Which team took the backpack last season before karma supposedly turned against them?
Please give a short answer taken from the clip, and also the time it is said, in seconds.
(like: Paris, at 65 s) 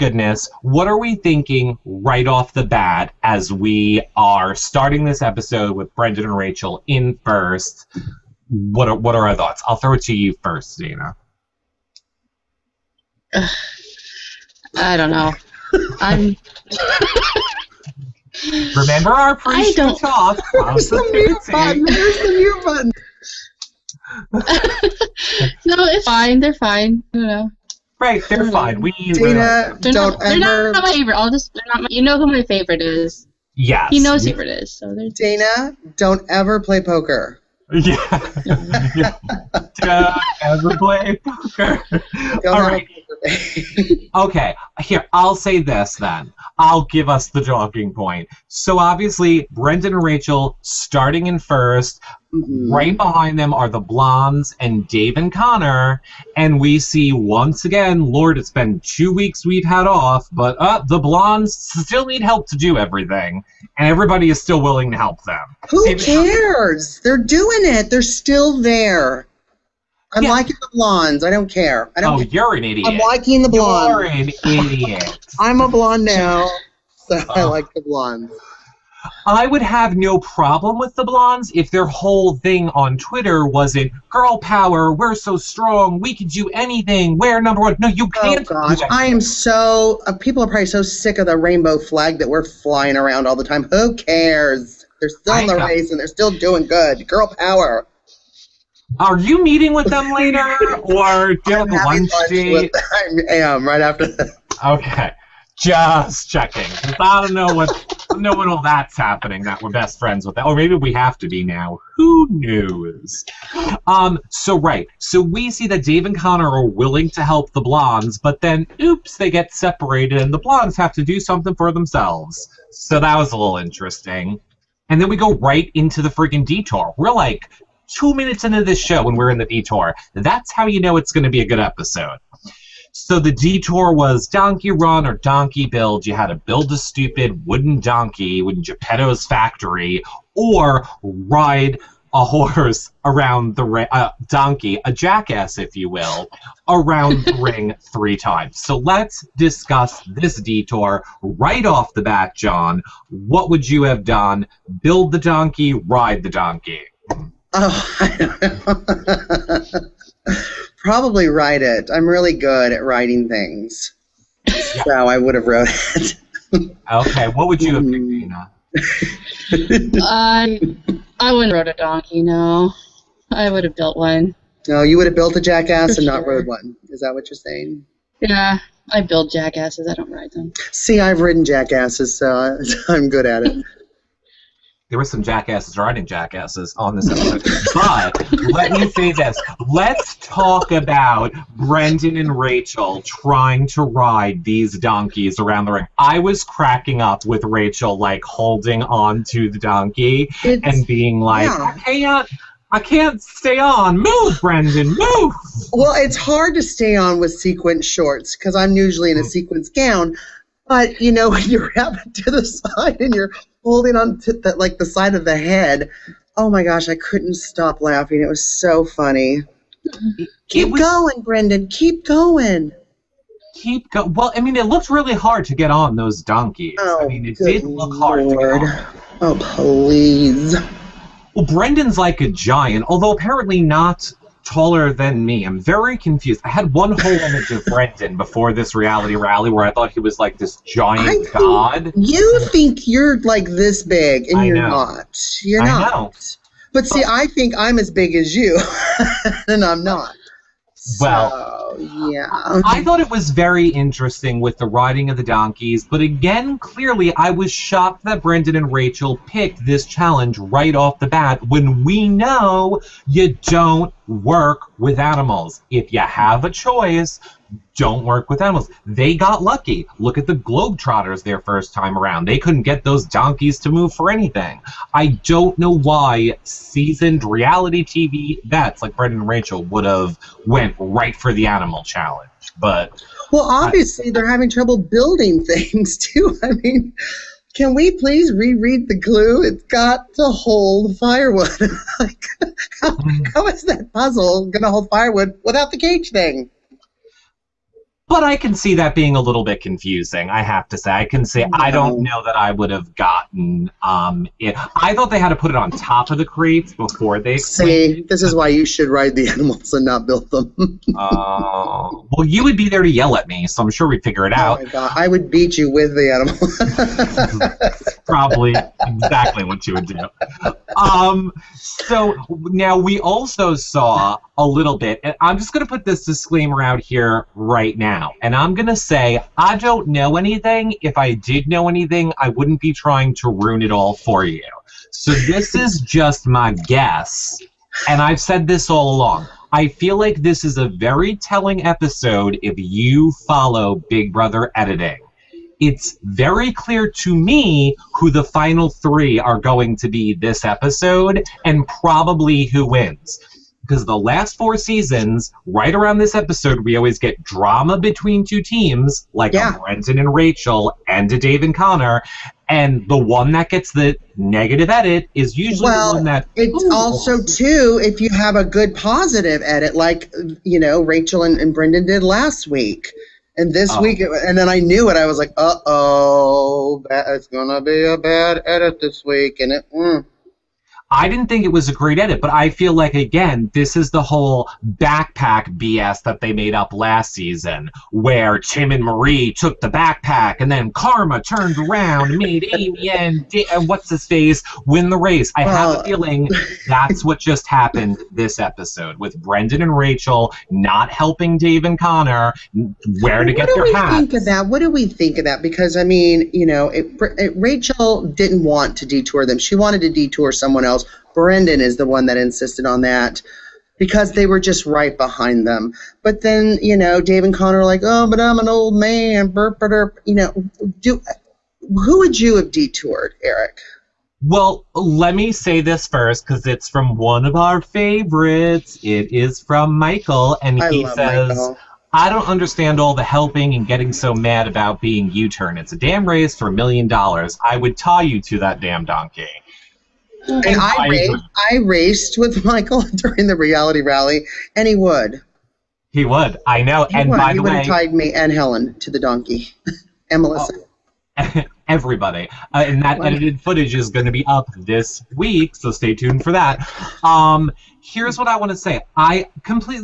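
Tim and Marie, at 388 s.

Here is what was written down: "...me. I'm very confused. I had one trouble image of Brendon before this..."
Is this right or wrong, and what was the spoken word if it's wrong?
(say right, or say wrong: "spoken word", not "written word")
wrong: "whole", not "trouble".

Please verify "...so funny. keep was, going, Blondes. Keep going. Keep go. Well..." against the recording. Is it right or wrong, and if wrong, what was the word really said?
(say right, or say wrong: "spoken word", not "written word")
wrong: "Brendon", not "Blondes".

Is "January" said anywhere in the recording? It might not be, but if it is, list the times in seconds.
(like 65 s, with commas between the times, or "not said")
not said.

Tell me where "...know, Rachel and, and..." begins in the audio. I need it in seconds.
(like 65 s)
370 s.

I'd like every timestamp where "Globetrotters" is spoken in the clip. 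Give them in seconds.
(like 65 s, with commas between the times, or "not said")
270 s.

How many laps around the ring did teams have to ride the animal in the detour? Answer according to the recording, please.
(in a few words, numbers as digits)
3.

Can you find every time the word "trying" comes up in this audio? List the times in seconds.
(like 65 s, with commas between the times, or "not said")
193 s, 332 s.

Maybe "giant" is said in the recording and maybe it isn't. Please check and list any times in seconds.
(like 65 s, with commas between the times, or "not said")
232 s, 240 s.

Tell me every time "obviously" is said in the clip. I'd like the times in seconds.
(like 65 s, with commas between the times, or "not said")
48 s, 283 s.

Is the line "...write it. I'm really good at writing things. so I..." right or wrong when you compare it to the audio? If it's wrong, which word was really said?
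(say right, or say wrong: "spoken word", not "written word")
right.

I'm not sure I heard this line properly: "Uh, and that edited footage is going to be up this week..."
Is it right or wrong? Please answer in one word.
right.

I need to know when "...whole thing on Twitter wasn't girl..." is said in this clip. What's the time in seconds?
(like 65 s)
81 s.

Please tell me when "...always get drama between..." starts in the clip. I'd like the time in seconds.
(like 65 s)
356 s.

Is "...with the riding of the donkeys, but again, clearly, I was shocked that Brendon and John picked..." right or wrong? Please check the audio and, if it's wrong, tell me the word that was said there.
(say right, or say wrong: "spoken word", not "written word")
wrong: "Rachel", not "John".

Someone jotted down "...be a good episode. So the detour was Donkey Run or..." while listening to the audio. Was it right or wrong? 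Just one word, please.
right.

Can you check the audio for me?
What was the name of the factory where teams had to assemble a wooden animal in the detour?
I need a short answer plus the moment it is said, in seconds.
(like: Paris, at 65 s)
Geppetto's factory, at 138 s.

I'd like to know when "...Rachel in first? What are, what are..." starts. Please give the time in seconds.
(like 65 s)
6 s.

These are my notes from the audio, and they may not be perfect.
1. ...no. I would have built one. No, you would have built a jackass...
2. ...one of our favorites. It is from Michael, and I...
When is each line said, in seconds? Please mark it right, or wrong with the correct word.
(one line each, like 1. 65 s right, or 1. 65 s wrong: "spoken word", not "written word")
1. 172 s right
2. 426 s right.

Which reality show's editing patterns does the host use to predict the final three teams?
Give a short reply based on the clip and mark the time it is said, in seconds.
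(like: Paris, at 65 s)
Big Brother, at 343 s.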